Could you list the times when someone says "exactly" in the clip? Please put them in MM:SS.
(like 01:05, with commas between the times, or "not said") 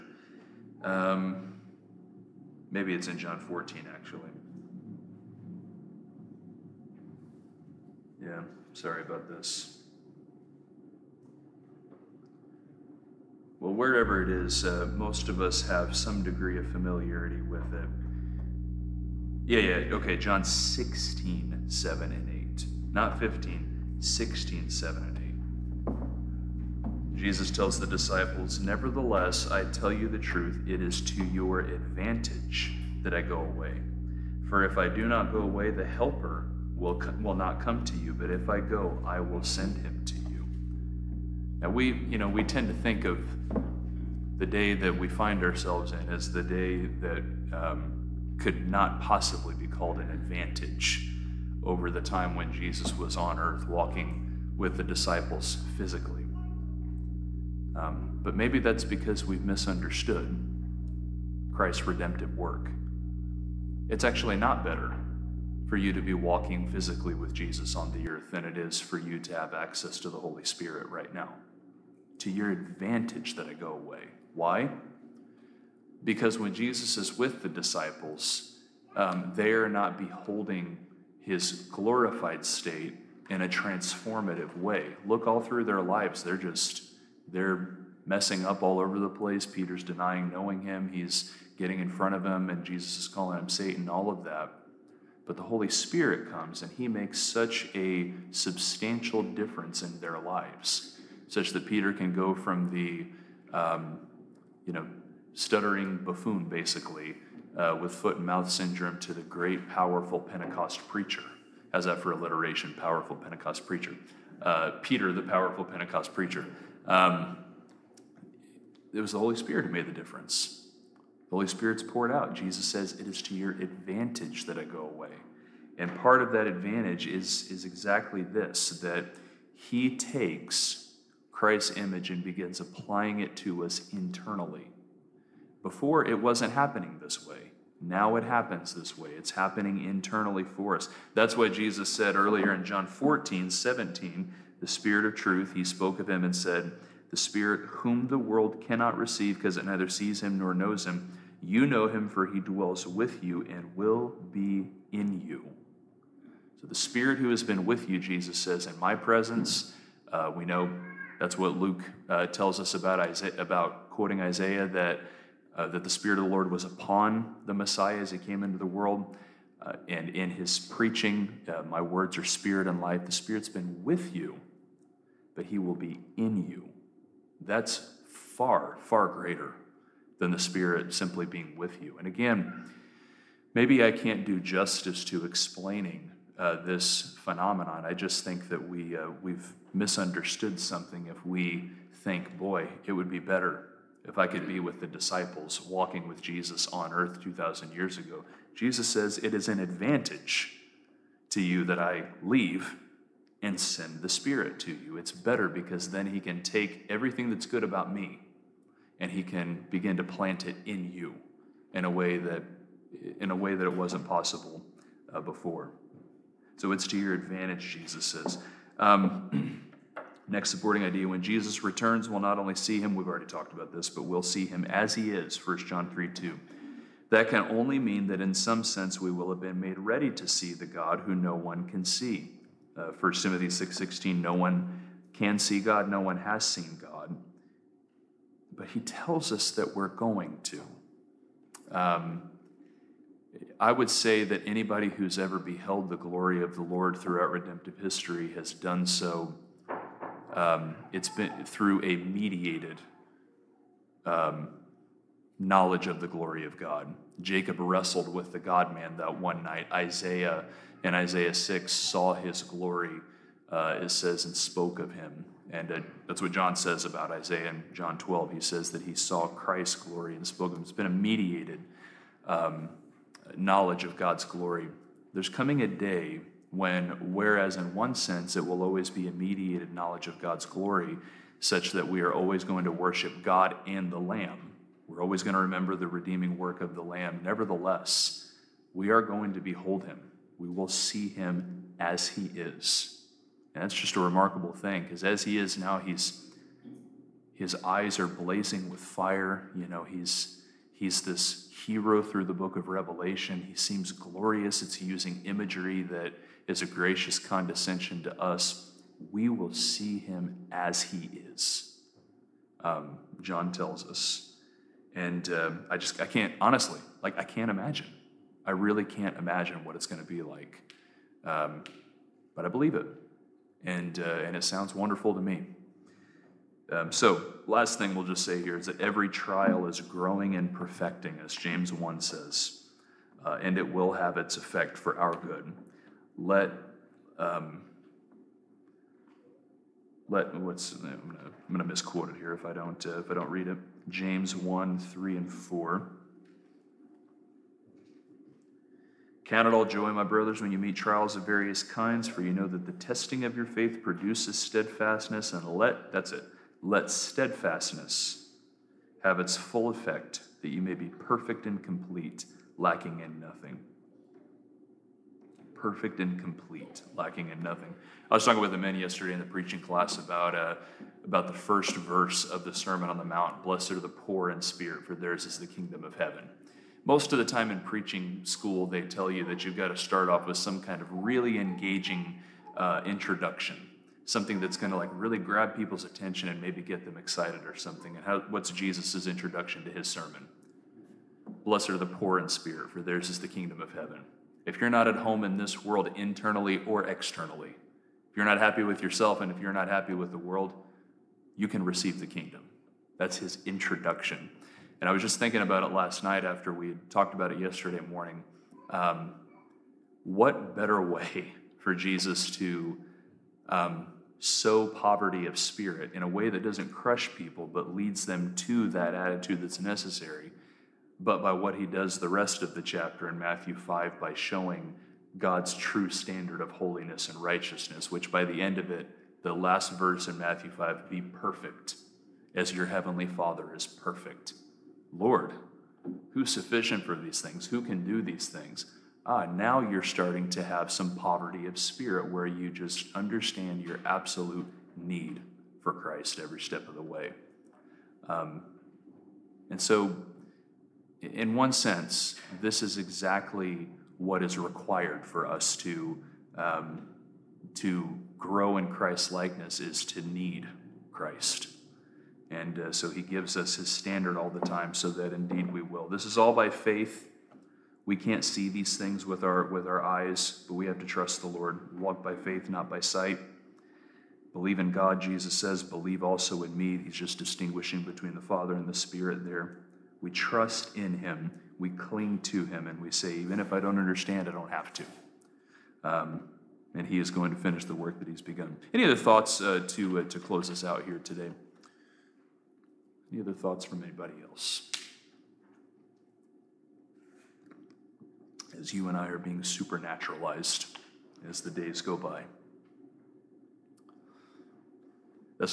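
02:07, 07:32.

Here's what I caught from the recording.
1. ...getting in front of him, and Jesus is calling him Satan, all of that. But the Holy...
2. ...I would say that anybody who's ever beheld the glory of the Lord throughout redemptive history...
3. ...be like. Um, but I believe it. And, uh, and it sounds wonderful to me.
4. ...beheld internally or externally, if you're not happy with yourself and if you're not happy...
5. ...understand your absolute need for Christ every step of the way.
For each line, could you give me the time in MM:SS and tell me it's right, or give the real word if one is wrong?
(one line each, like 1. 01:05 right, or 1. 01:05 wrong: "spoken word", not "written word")
1. 01:31 right
2. 04:03 right
3. 05:20 right
4. 06:35 wrong: "world", not "beheld"
5. 07:22 right.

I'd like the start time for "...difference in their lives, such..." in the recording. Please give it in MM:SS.
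01:39.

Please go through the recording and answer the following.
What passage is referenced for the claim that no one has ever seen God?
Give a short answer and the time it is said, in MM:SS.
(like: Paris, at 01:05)
1 Timothy 6:16, at 03:52.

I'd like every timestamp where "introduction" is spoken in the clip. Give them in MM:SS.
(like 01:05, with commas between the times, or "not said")
06:22, 06:29, 06:43.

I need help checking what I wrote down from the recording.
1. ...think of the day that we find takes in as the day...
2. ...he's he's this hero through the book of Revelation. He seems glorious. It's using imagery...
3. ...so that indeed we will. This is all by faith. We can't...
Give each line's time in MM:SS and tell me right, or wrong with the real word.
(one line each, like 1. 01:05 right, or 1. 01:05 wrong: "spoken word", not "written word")
1. 00:42 wrong: "ourselves", not "takes"
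2. 04:59 right
3. 07:44 right.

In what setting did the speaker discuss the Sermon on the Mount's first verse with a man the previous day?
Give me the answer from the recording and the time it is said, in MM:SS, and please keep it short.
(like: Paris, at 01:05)
Preaching class, at 06:09.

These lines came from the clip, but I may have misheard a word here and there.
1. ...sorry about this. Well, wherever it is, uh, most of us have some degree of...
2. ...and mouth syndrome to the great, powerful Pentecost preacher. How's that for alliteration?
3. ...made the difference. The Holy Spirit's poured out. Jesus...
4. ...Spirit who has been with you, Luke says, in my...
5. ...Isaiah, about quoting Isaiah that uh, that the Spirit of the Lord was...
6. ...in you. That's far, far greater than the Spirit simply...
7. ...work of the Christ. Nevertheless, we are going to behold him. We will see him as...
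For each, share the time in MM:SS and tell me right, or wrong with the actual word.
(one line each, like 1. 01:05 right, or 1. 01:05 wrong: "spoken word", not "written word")
1. 00:08 right
2. 01:48 right
3. 01:59 right
4. 02:36 wrong: "Jesus", not "Luke"
5. 02:43 right
6. 02:56 right
7. 04:46 wrong: "Lamb", not "Christ".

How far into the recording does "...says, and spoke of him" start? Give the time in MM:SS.
04:23.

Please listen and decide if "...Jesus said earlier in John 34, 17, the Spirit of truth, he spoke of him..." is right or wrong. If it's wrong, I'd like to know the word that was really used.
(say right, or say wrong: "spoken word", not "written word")
wrong: "14", not "34".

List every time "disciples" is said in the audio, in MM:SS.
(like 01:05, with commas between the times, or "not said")
00:27, 00:54, 01:17, 03:14.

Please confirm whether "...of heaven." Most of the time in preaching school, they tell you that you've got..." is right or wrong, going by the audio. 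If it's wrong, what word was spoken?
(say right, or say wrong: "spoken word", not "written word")
right.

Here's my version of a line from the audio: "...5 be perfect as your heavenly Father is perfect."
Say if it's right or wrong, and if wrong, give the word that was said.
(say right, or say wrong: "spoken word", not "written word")
right.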